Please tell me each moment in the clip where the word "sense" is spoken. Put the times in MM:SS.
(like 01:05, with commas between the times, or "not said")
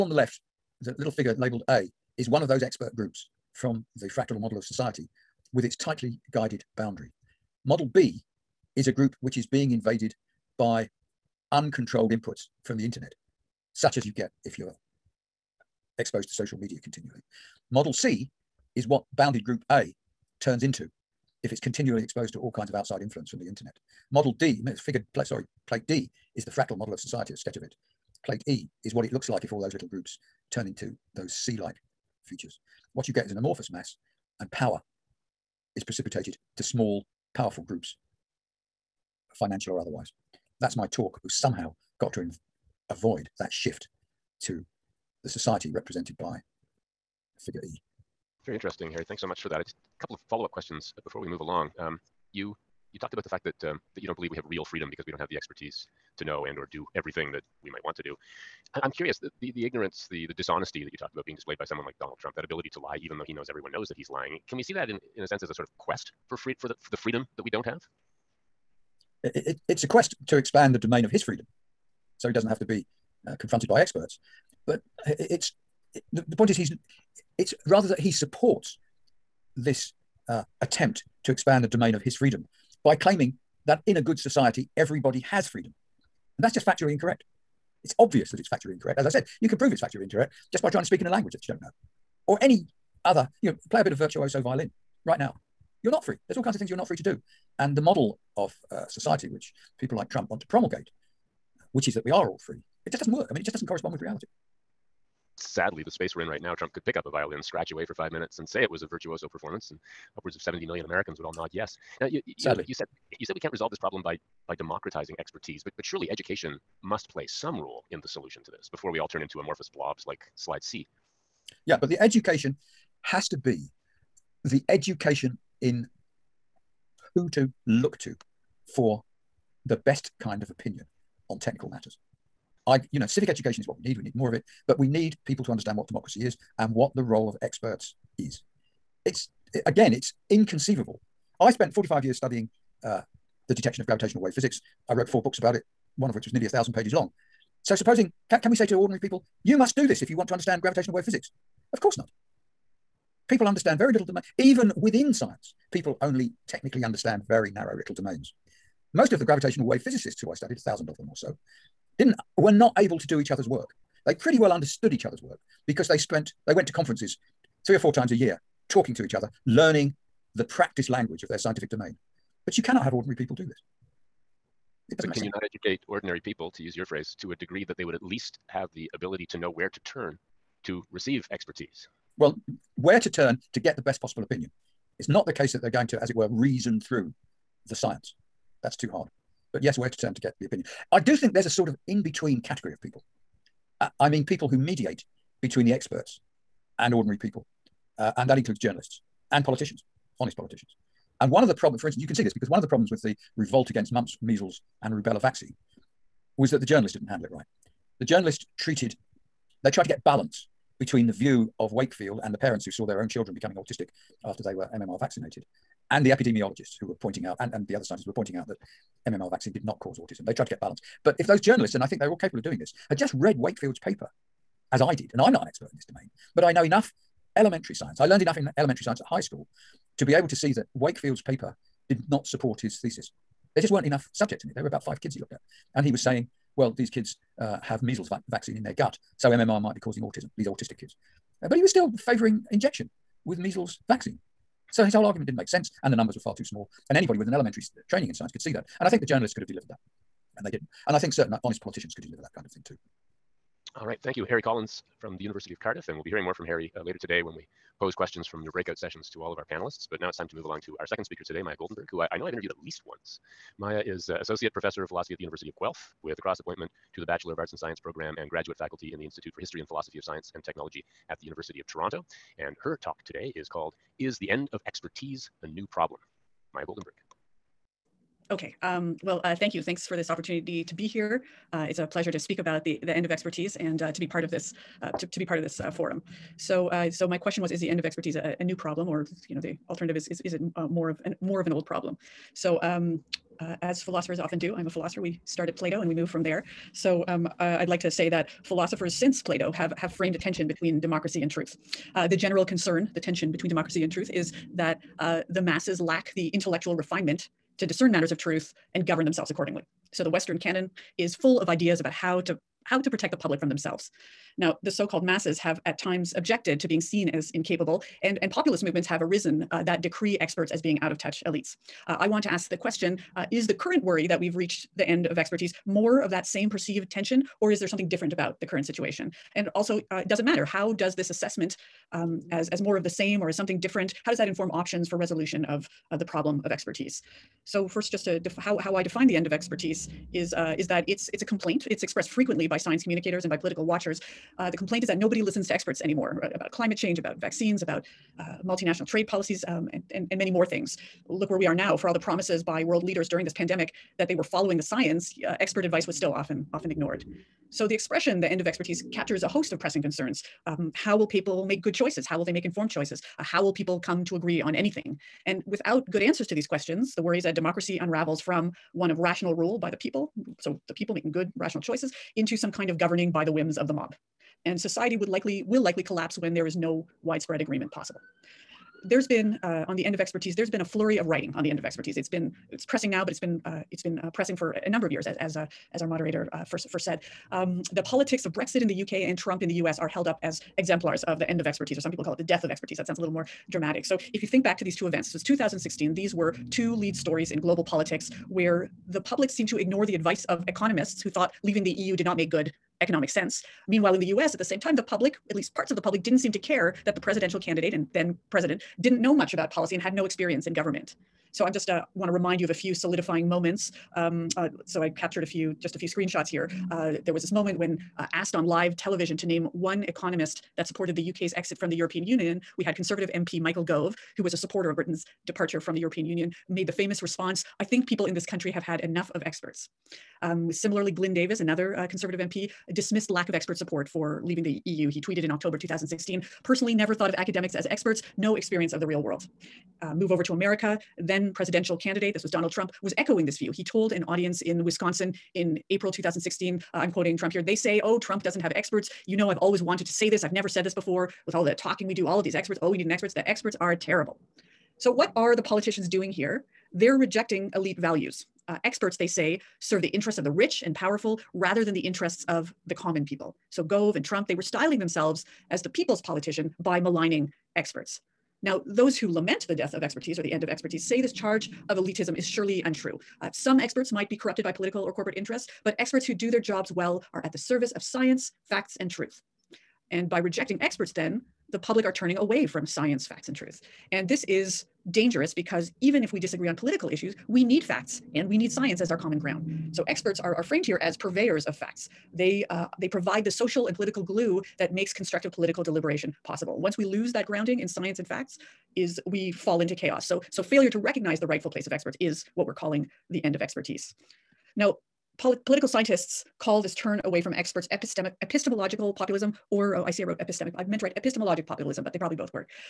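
01:05, 02:55, 04:05, 06:43.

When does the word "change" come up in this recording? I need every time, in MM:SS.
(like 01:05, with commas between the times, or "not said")
05:46.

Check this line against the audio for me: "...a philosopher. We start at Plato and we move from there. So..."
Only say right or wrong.
right.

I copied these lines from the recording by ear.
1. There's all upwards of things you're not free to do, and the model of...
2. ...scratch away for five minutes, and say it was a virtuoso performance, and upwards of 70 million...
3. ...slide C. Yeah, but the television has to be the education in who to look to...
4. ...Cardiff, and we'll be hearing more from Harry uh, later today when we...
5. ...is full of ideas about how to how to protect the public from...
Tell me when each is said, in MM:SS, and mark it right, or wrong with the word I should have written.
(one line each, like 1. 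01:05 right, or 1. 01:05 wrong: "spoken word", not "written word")
1. 01:36 wrong: "kinds", not "upwards"
2. 01:47 right
3. 02:00 wrong: "education", not "television"
4. 04:15 right
5. 05:10 right.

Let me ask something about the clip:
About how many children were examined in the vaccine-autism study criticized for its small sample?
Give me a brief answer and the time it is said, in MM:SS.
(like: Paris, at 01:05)
5, at 03:54.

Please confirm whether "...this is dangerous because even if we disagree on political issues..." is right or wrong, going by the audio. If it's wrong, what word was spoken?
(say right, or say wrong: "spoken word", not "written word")
right.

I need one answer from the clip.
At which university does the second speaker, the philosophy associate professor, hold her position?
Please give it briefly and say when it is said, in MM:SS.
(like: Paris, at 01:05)
University of Guelph, at 04:25.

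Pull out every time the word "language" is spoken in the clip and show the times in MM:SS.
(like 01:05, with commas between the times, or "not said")
01:31, 02:50.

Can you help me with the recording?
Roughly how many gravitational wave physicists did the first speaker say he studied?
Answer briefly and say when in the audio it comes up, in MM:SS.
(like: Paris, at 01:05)
1000, at 02:40.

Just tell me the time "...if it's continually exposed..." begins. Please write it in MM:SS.
00:21.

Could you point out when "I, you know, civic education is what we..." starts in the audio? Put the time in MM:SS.
02:12.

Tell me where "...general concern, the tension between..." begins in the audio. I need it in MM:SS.
05:02.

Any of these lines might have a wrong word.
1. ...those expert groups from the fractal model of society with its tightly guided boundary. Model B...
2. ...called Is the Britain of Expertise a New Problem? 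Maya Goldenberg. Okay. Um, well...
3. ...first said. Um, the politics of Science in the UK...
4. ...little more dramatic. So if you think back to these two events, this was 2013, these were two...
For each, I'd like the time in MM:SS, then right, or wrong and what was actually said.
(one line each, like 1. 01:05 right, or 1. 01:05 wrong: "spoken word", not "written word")
1. 00:02 right
2. 04:33 wrong: "End", not "Britain"
3. 06:26 wrong: "Brexit", not "Science"
4. 06:32 wrong: "2016", not "2013".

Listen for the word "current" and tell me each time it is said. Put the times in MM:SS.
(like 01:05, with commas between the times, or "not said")
05:23, 05:28.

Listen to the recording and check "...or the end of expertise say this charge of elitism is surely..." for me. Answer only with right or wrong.
right.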